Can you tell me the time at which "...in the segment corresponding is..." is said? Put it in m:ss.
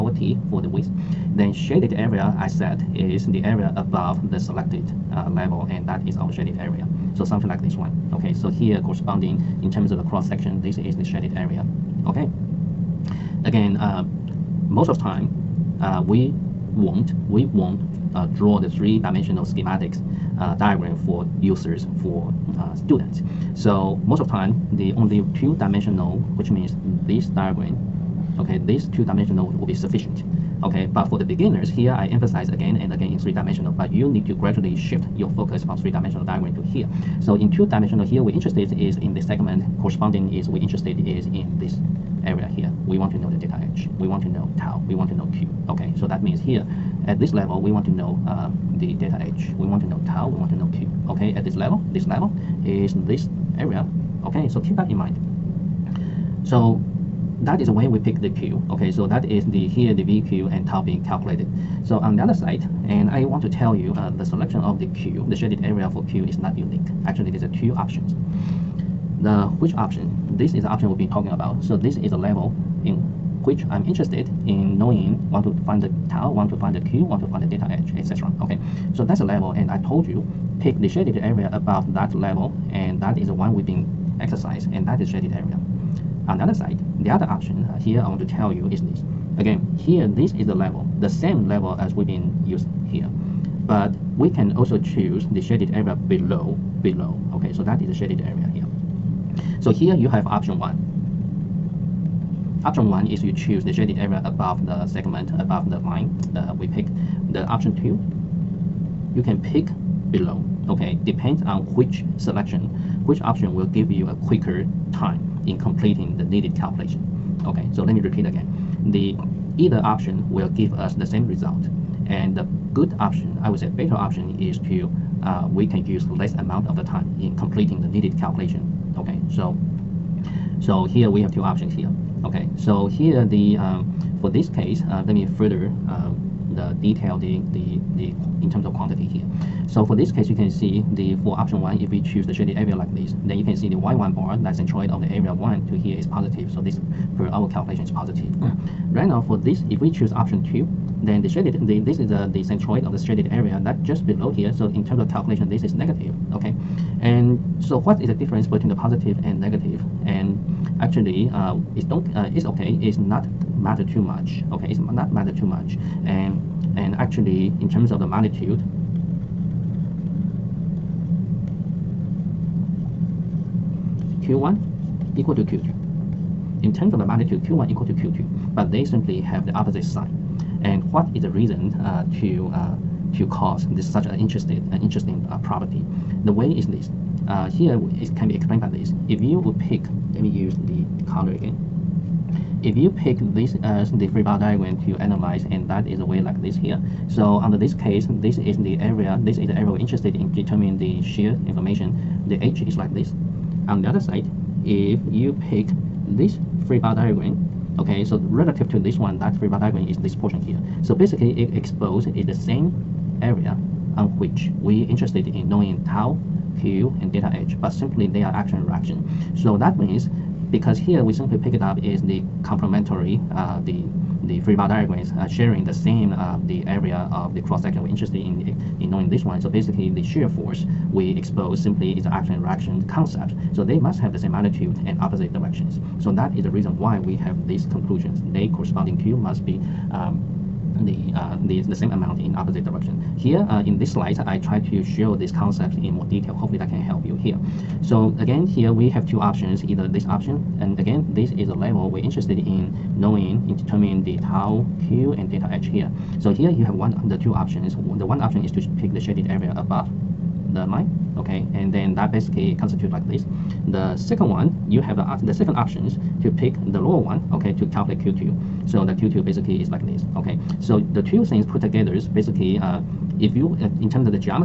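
0:38.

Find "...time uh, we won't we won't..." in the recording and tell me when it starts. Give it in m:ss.
0:15.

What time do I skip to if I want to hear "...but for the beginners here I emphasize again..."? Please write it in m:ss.
0:30.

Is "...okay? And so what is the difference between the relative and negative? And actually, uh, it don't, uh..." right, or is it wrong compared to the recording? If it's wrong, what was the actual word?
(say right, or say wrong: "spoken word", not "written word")
wrong: "positive", not "relative".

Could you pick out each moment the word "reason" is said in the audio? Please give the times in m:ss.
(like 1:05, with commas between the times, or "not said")
3:01, 3:56.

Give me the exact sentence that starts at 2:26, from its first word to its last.
So this per our calculation is positive.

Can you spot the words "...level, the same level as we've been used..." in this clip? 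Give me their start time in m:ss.
1:30.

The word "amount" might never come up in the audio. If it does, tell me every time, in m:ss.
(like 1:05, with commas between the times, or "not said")
2:06, 4:01.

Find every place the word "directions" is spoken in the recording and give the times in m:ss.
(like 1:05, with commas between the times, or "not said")
3:55, 4:02.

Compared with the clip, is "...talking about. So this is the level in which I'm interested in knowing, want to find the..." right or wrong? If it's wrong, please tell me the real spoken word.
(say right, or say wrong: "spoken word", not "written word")
right.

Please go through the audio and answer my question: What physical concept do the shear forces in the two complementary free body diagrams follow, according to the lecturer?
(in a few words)
Action-reaction.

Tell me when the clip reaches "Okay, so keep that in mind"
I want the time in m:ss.
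0:54.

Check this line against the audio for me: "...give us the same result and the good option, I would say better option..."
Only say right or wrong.
right.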